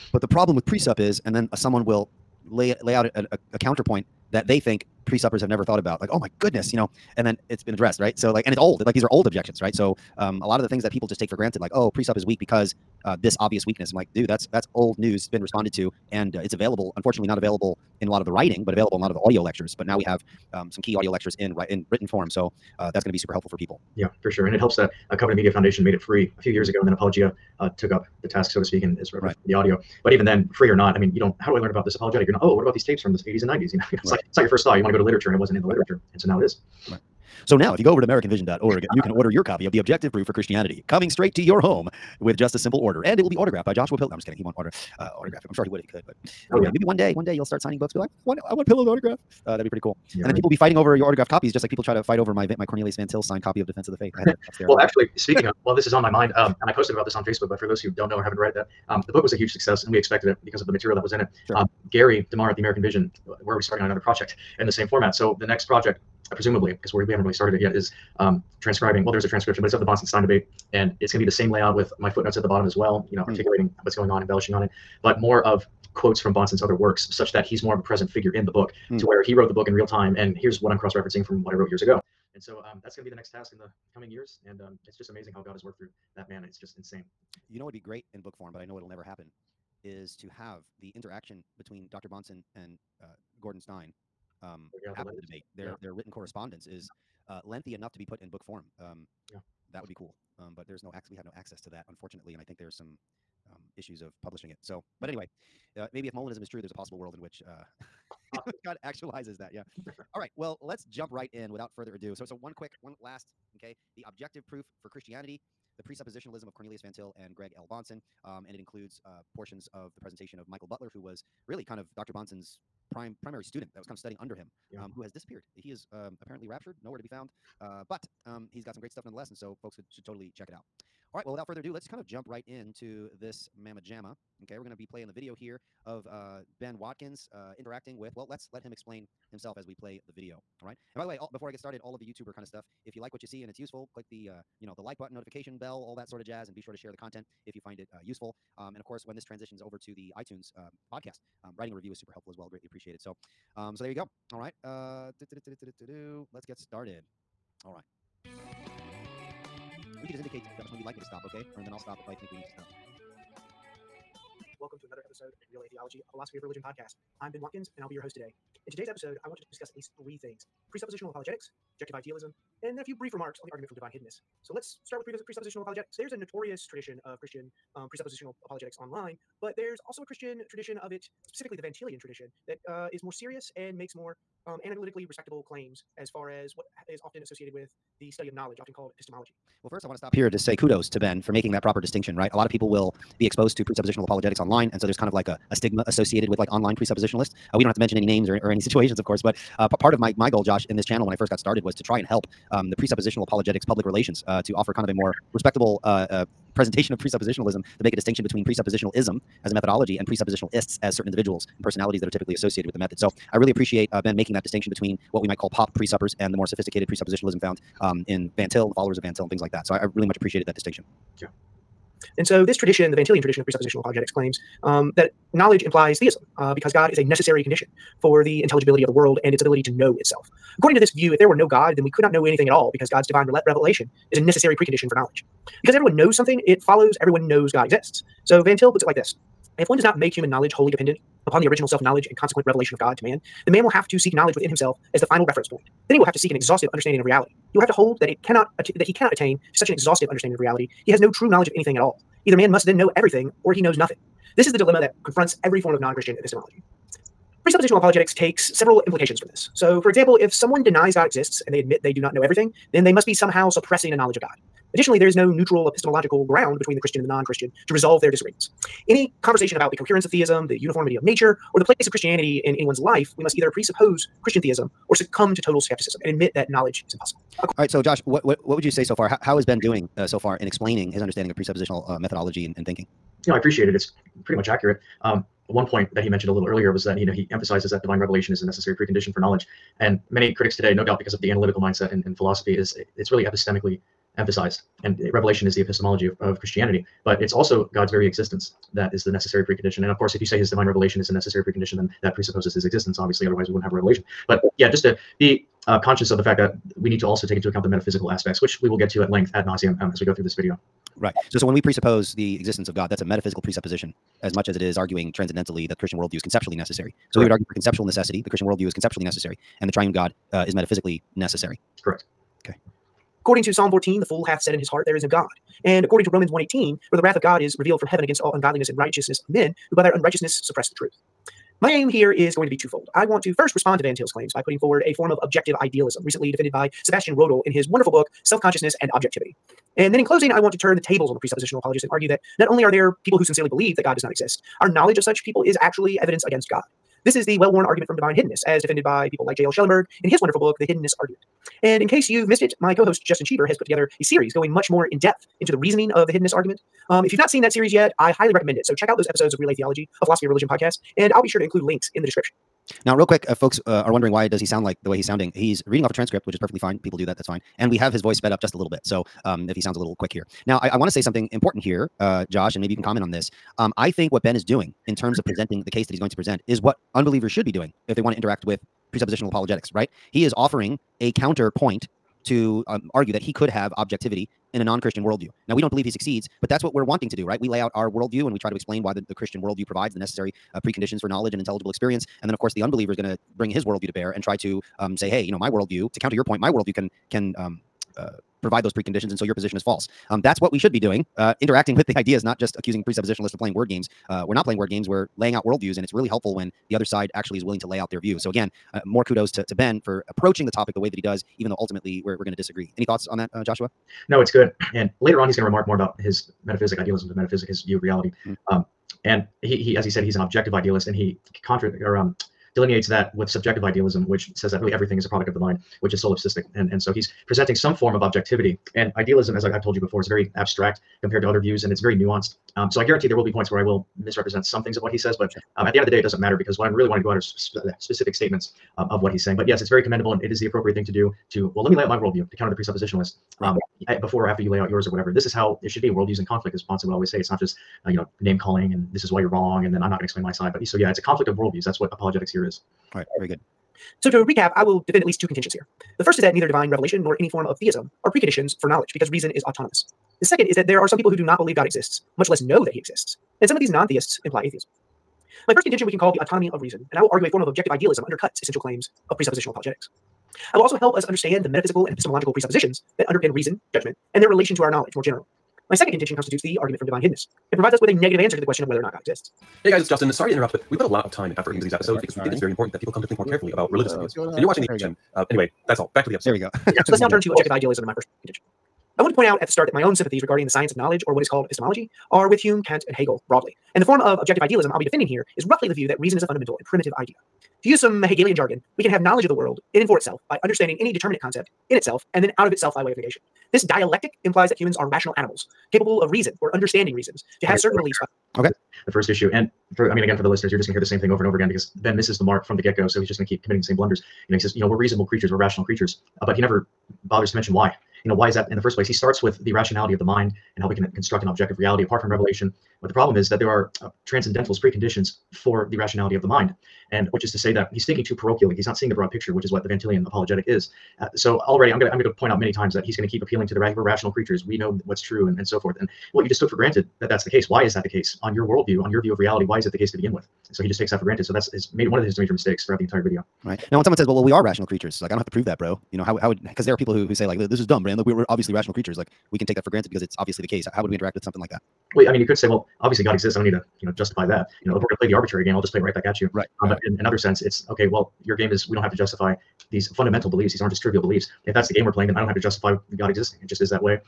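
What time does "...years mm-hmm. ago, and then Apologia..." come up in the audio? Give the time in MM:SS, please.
00:26.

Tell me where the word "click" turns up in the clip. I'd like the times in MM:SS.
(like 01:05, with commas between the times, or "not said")
02:23.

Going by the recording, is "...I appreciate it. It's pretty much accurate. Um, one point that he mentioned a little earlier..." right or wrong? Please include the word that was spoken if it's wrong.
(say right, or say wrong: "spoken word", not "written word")
right.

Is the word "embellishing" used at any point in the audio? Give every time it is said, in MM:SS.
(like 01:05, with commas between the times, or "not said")
01:14.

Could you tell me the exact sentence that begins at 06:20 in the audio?
He is offering a counterpoint to um, argue that he could have objectivity in a non Christian worldview.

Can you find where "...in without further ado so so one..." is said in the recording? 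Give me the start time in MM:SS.
01:51.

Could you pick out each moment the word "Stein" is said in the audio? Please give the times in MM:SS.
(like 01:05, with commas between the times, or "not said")
01:09, 01:33.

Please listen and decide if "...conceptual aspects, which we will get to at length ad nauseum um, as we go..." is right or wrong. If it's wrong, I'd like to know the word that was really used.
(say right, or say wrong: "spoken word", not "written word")
wrong: "metaphysical", not "conceptual".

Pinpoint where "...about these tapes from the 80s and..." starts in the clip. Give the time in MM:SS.
00:32.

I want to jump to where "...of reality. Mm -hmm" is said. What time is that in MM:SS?
06:57.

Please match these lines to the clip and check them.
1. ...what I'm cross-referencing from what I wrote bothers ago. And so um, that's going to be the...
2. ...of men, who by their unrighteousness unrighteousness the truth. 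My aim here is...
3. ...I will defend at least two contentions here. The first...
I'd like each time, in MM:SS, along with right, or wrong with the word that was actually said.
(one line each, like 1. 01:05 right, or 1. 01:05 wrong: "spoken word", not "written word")
1. 01:20 wrong: "years", not "bothers"
2. 05:29 wrong: "suppress", not "unrighteousness"
3. 07:34 right.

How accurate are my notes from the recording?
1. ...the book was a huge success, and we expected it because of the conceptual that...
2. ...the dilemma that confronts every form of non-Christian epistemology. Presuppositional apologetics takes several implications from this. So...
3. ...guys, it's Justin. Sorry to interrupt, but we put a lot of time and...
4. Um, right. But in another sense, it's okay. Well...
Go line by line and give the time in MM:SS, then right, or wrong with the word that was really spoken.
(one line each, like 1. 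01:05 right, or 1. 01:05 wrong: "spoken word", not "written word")
1. 00:59 wrong: "material", not "conceptual"
2. 04:14 right
3. 07:59 right
4. 09:16 right.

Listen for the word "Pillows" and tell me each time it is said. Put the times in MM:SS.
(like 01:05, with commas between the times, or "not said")
00:43, 00:48.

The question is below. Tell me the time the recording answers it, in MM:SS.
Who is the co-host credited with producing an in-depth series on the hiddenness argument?
05:53.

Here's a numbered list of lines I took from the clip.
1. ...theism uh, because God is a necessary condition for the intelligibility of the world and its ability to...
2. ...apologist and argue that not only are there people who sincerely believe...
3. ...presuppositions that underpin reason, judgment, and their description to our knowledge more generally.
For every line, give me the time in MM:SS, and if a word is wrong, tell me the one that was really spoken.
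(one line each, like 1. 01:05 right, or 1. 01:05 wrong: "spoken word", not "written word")
1. 03:45 right
2. 05:41 right
3. 07:52 wrong: "relation", not "description".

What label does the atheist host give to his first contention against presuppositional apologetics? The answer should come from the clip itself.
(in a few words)
autonomy of reason.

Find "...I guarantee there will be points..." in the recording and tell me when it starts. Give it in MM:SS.
07:12.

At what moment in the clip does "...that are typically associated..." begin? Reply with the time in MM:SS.
03:32.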